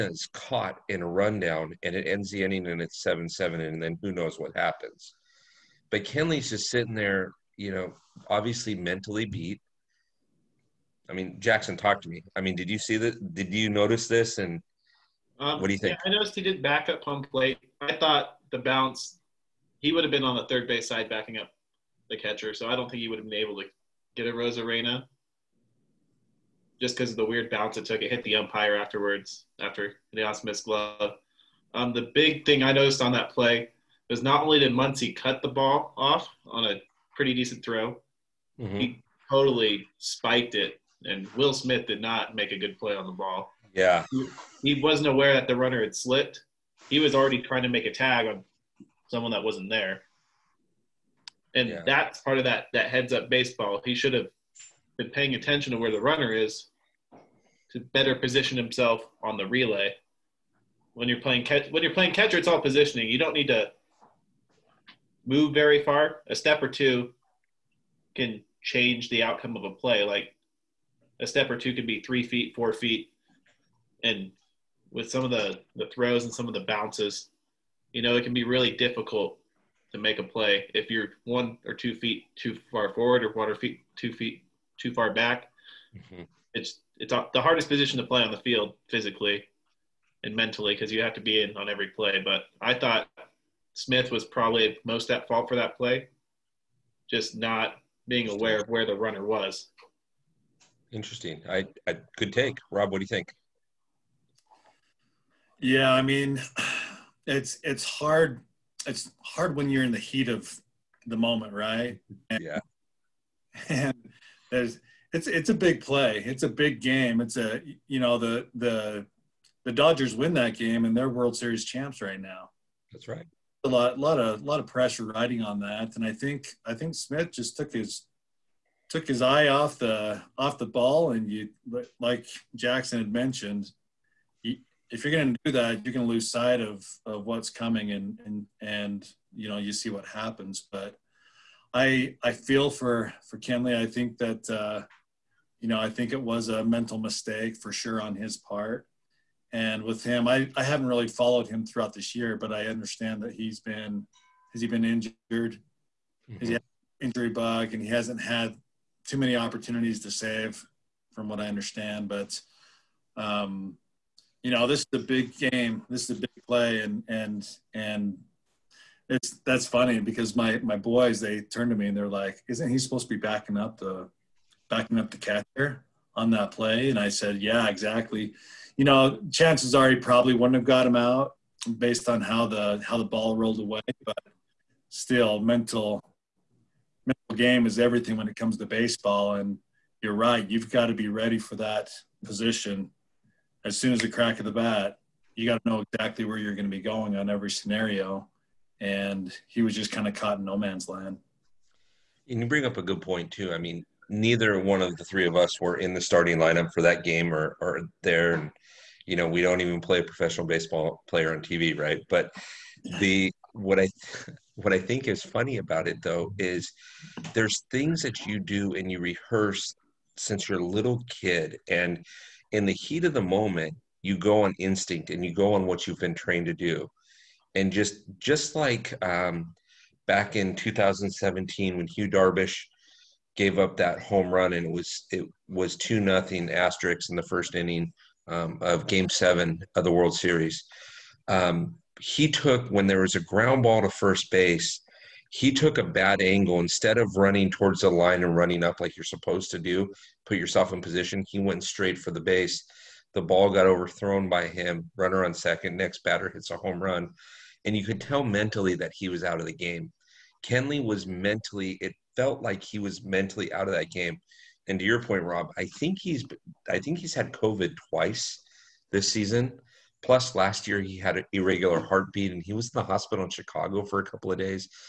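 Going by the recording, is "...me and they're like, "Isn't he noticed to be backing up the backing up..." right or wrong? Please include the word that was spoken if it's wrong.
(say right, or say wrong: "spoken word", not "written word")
wrong: "supposed", not "noticed".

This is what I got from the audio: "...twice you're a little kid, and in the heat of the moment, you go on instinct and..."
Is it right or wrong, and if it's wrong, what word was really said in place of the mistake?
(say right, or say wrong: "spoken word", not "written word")
wrong: "since", not "twice".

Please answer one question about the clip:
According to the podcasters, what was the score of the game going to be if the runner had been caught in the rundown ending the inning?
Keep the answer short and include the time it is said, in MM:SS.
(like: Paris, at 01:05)
7-7, at 00:03.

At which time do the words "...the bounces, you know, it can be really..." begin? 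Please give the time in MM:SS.
01:16.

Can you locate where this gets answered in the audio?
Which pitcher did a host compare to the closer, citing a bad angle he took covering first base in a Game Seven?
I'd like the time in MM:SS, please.
03:51.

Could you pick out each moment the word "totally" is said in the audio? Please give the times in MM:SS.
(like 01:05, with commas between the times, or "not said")
00:39.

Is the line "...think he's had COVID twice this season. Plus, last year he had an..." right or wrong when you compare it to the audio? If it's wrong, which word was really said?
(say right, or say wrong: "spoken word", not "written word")
right.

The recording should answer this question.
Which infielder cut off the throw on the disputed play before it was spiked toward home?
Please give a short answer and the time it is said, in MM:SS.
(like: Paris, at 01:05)
Muncy, at 00:34.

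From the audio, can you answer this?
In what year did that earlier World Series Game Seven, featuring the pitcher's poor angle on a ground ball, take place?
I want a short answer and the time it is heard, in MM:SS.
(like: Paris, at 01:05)
2017, at 03:50.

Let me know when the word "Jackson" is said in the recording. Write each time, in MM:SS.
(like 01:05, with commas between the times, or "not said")
00:11, 02:12.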